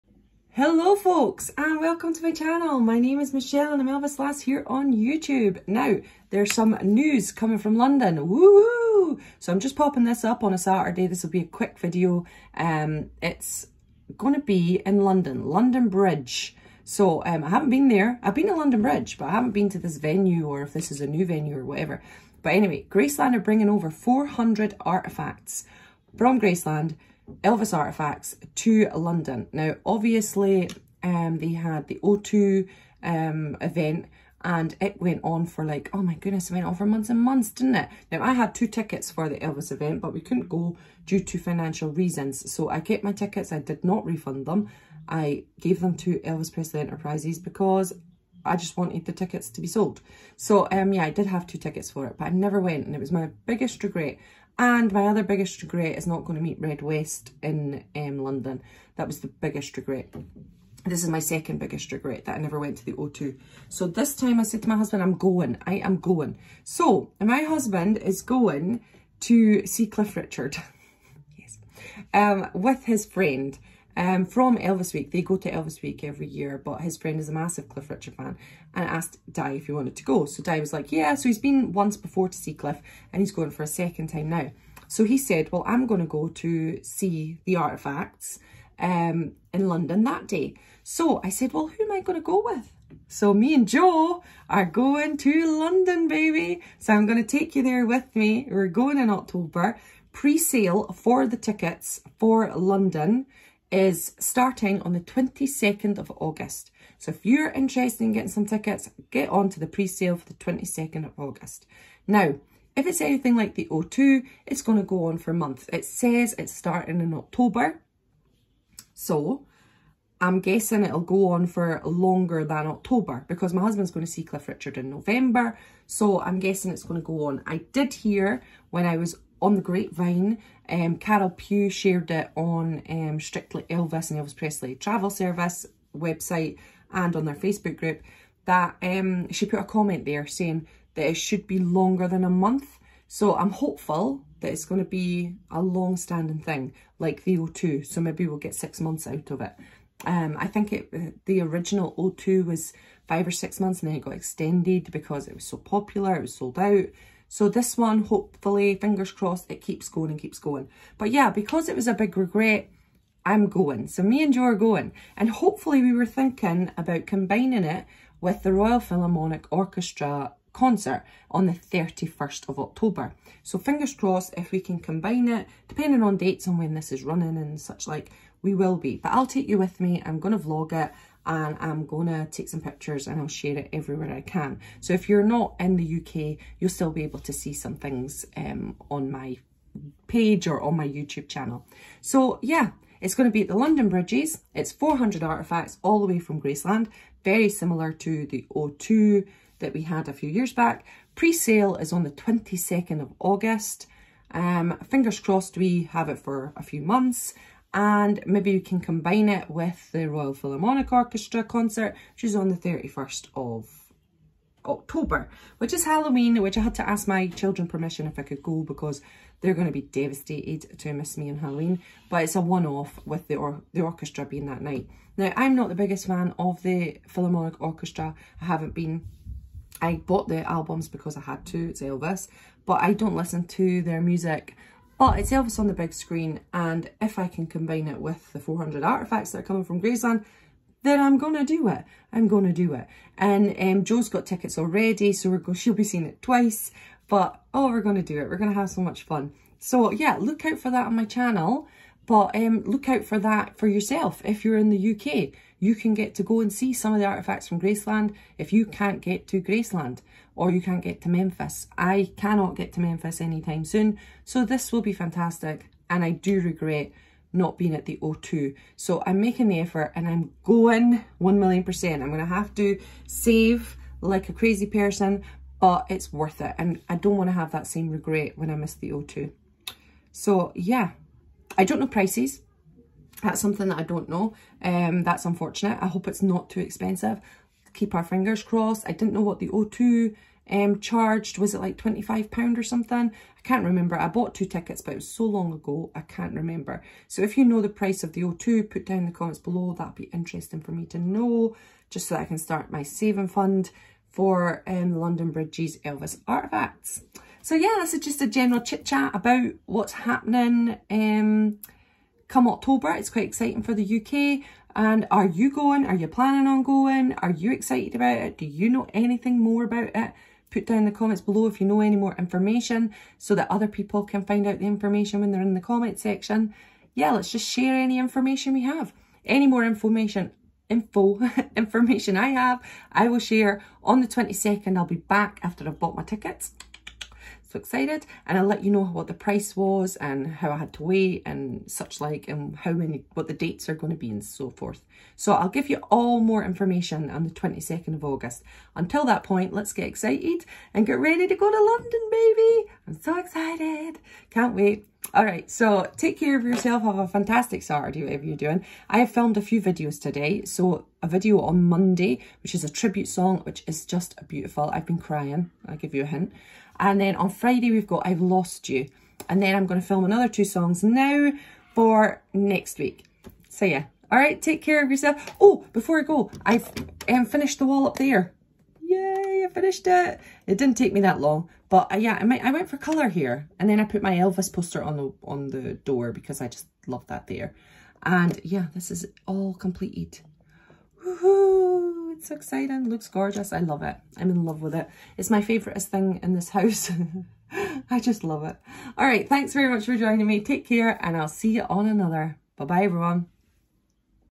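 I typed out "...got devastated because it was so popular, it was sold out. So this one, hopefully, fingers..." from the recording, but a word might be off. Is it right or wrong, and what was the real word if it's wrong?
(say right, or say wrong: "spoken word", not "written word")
wrong: "extended", not "devastated".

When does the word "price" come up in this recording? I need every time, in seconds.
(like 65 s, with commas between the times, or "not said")
281 s, 297 s, 339 s.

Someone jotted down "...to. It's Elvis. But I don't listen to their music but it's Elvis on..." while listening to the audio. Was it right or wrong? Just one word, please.
right.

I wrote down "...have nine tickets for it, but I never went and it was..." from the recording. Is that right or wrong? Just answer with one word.
wrong.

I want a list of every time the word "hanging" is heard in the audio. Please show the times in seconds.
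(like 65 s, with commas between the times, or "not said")
not said.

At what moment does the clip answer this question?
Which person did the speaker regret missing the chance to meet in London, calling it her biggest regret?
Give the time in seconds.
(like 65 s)
56 s.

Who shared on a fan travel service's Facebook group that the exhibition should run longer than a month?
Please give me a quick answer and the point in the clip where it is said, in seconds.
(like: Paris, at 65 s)
Carol Pugh, at 130 s.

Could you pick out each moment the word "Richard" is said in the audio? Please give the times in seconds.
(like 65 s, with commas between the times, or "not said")
70 s, 77 s, 124 s.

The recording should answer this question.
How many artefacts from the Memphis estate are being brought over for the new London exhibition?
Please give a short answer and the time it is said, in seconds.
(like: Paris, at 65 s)
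400, at 23 s.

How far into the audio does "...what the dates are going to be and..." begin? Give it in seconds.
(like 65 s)
343 s.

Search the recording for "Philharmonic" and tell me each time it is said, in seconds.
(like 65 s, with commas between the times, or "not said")
168 s, 210 s, 227 s.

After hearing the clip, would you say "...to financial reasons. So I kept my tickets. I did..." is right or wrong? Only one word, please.
right.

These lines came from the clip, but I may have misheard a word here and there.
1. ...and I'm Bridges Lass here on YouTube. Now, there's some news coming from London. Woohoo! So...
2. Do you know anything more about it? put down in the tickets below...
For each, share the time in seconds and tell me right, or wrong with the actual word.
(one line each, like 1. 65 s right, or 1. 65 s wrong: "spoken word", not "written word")
1. 3 s wrong: "Elvis", not "Bridges"
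2. 318 s wrong: "comments", not "tickets".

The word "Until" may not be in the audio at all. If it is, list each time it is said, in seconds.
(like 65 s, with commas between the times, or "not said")
348 s.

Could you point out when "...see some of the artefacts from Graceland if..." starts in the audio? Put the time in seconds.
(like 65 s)
256 s.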